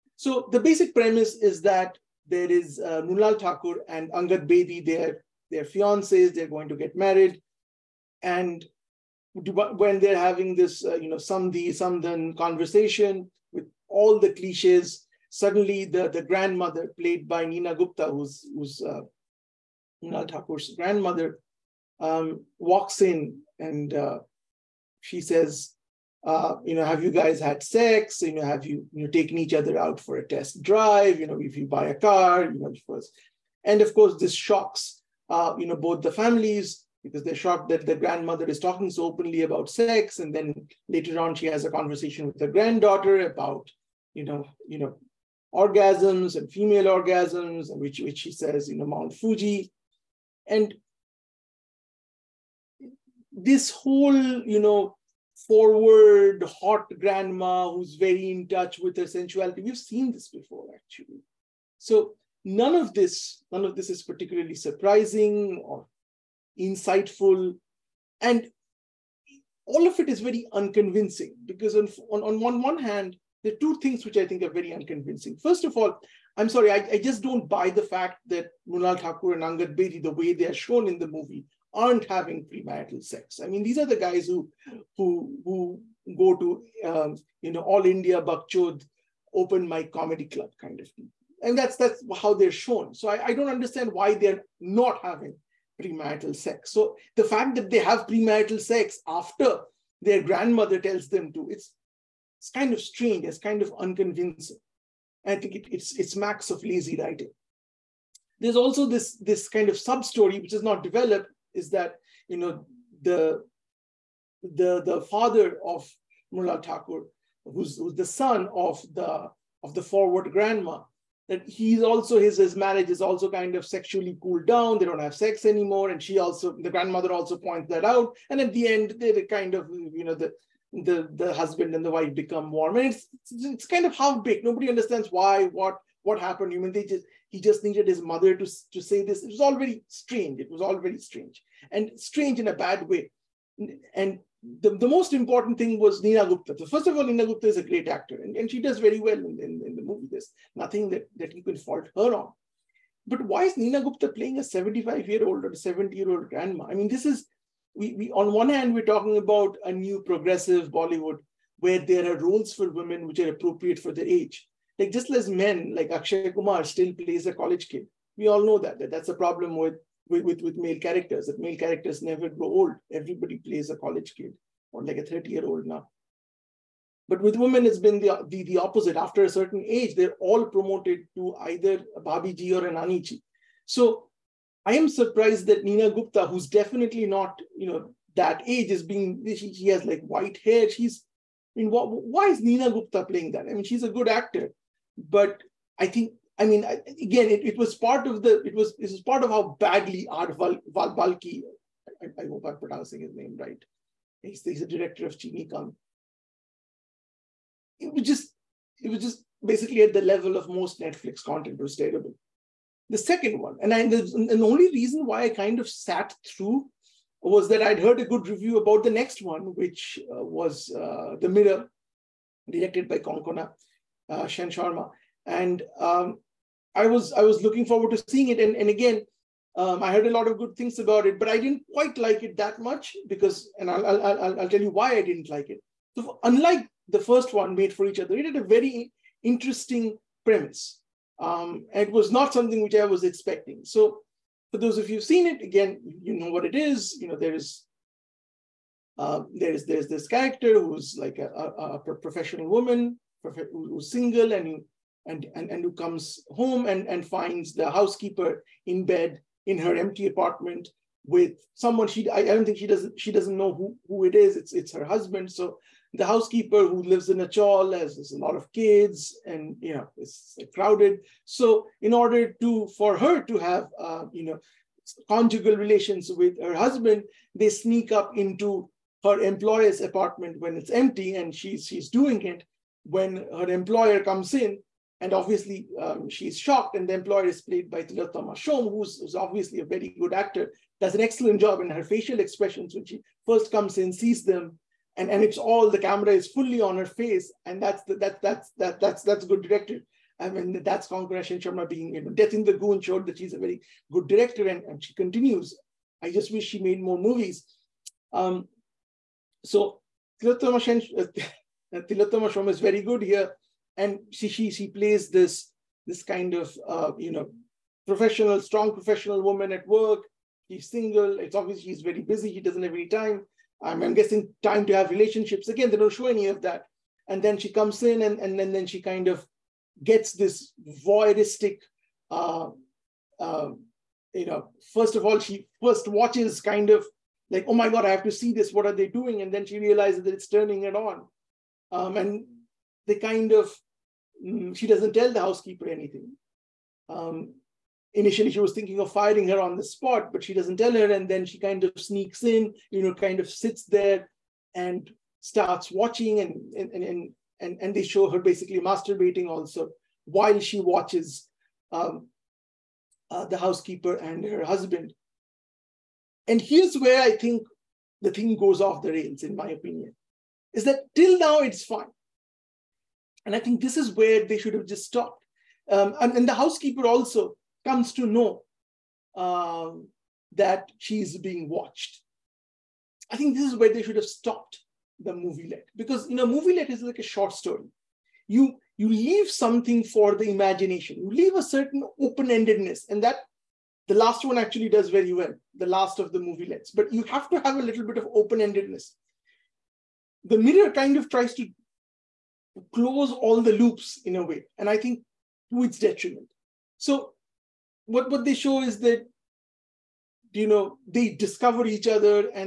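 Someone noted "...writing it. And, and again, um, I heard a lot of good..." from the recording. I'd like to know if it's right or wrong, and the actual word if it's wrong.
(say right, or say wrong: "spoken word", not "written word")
wrong: "seeing", not "writing".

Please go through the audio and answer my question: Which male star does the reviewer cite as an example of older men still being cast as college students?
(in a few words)
Akshay Kumar.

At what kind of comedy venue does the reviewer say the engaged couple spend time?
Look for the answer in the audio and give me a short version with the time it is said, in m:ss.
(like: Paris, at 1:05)
All India Bakchod open mic, at 1:27.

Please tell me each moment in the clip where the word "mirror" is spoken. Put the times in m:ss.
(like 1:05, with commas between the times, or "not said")
3:41, 6:40.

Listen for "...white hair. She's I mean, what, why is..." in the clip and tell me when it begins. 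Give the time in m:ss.
3:10.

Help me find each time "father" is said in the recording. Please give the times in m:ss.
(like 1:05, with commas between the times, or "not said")
1:55.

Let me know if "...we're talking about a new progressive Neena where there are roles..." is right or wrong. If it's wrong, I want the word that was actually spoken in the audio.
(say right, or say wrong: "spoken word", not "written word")
wrong: "Bollywood", not "Neena".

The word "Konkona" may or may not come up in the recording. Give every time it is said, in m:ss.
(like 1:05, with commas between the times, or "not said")
3:42, 5:00.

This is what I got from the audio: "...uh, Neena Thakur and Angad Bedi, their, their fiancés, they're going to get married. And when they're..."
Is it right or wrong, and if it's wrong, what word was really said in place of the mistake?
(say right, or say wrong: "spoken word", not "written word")
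wrong: "Mrunal", not "Neena".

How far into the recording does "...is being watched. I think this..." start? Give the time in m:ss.
6:21.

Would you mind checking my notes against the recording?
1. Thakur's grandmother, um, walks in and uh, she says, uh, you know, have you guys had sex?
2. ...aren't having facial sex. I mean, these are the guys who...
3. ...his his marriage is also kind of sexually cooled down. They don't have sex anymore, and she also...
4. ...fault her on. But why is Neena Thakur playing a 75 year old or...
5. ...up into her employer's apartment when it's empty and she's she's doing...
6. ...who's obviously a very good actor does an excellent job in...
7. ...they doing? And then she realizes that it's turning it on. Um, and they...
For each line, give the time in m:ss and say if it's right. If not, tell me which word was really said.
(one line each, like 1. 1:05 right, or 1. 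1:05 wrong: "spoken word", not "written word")
1. 0:20 right
2. 1:21 wrong: "premarital", not "facial"
3. 2:02 right
4. 2:31 wrong: "Gupta", not "Thakur"
5. 4:37 right
6. 4:48 right
7. 5:38 right.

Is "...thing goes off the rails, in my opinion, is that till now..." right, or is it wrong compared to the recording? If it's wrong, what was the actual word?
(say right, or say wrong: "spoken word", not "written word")
right.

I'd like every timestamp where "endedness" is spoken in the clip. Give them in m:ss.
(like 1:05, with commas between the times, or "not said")
6:32, 6:38.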